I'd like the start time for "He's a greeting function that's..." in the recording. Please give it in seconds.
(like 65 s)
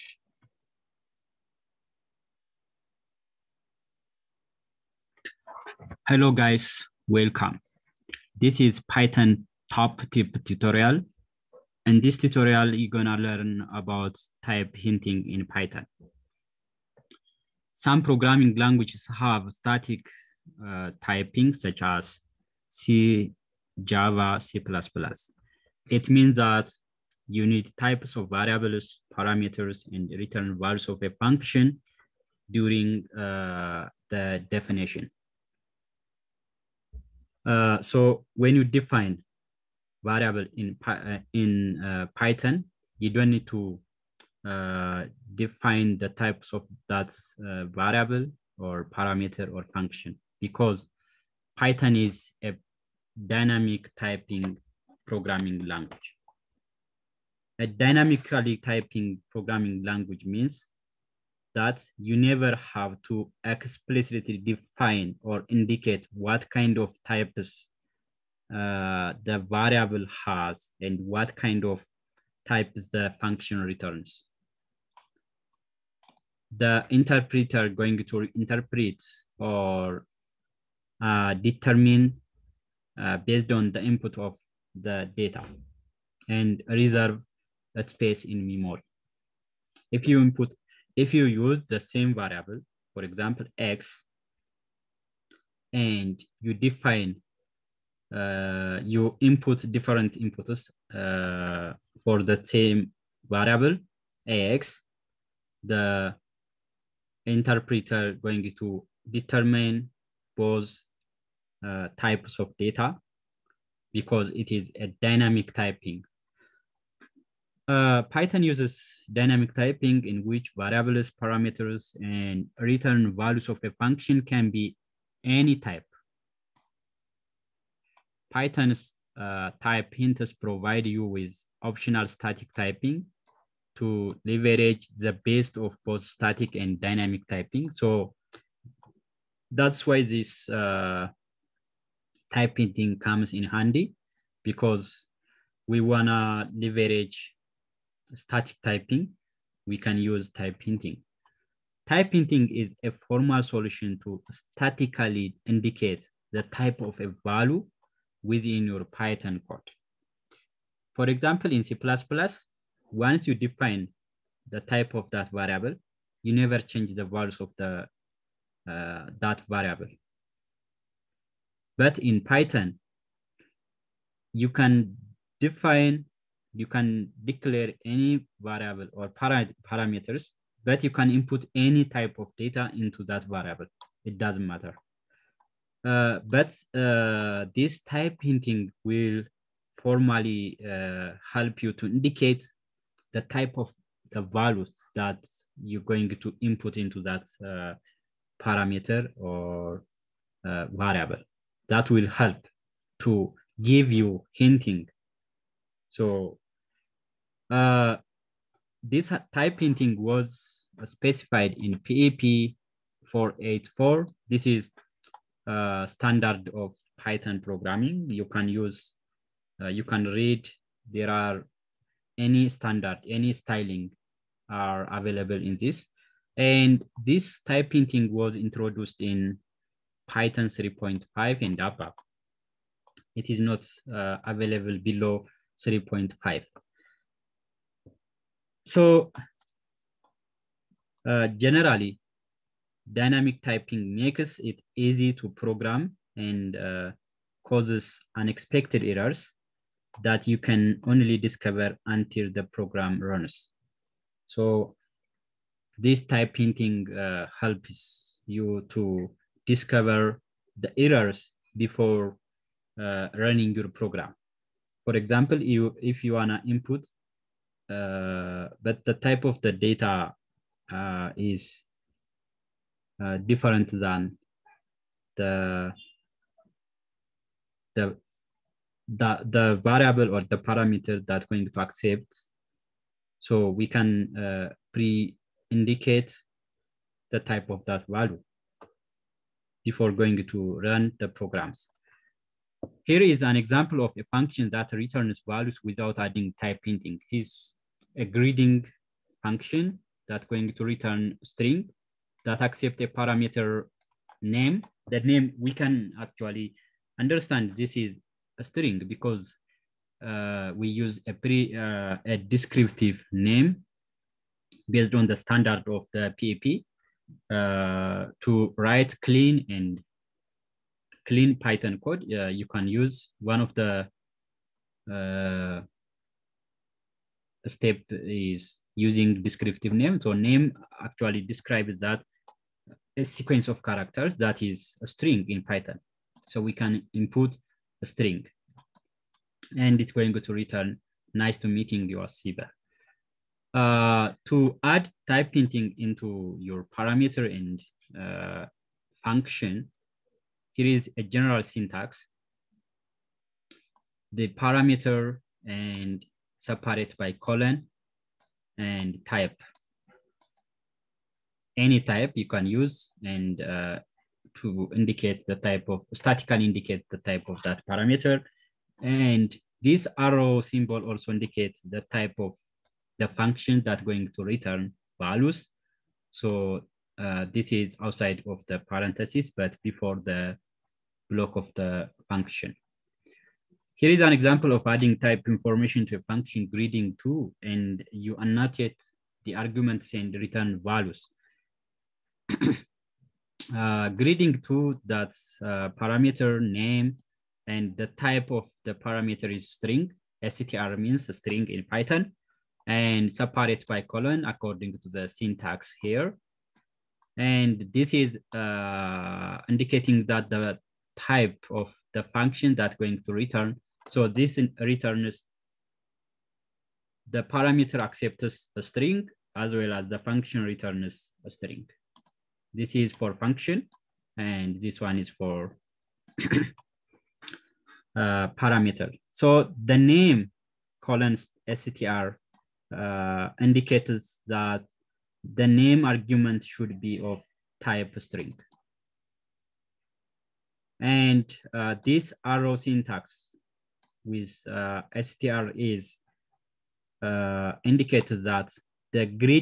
297 s.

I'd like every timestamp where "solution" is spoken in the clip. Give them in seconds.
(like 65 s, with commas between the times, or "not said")
153 s.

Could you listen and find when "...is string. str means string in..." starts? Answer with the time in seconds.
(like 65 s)
399 s.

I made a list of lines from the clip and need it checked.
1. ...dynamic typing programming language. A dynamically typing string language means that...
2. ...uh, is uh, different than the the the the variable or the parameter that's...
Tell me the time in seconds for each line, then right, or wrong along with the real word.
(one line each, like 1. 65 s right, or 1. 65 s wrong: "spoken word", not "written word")
1. 53 s wrong: "programming", not "string"
2. 270 s right.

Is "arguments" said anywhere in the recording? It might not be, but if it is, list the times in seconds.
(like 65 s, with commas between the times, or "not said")
389 s, 435 s.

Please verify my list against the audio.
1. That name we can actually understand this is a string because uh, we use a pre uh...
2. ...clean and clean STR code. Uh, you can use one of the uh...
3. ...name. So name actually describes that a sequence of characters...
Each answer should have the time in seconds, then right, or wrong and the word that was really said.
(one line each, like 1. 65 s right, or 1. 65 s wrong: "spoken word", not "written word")
1. 304 s right
2. 319 s wrong: "Python", not "STR"
3. 329 s right.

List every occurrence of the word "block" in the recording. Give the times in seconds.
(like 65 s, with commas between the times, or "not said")
381 s.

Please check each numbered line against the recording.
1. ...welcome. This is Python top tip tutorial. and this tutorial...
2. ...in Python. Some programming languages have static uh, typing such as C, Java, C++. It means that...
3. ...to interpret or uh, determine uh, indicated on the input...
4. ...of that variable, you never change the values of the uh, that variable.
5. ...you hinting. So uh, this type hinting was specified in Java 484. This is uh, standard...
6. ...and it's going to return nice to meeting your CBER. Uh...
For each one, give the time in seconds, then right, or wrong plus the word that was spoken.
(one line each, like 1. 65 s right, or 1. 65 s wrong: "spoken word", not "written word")
1. 7 s right
2. 15 s right
3. 78 s wrong: "based", not "indicated"
4. 164 s right
5. 203 s wrong: "PEP", not "Java"
6. 339 s right.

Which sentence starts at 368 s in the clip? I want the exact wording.
And this arrow symbol also indicates the type of the function that's going to return values.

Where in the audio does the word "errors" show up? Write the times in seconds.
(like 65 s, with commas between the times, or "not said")
248 s, 260 s.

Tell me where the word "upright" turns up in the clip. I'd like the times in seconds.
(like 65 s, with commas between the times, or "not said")
not said.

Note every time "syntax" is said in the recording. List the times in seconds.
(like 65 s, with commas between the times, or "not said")
351 s, 405 s, 442 s.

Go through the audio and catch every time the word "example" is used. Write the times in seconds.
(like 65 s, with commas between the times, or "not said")
93 s, 161 s, 264 s, 293 s, 384 s.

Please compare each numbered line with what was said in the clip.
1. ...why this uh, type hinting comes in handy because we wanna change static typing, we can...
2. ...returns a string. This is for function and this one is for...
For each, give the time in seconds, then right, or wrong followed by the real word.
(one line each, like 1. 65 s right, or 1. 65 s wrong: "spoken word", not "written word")
1. 139 s wrong: "leverage", not "change"
2. 420 s right.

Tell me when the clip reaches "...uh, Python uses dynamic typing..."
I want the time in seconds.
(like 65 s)
117 s.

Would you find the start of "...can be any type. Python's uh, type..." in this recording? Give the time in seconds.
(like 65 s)
124 s.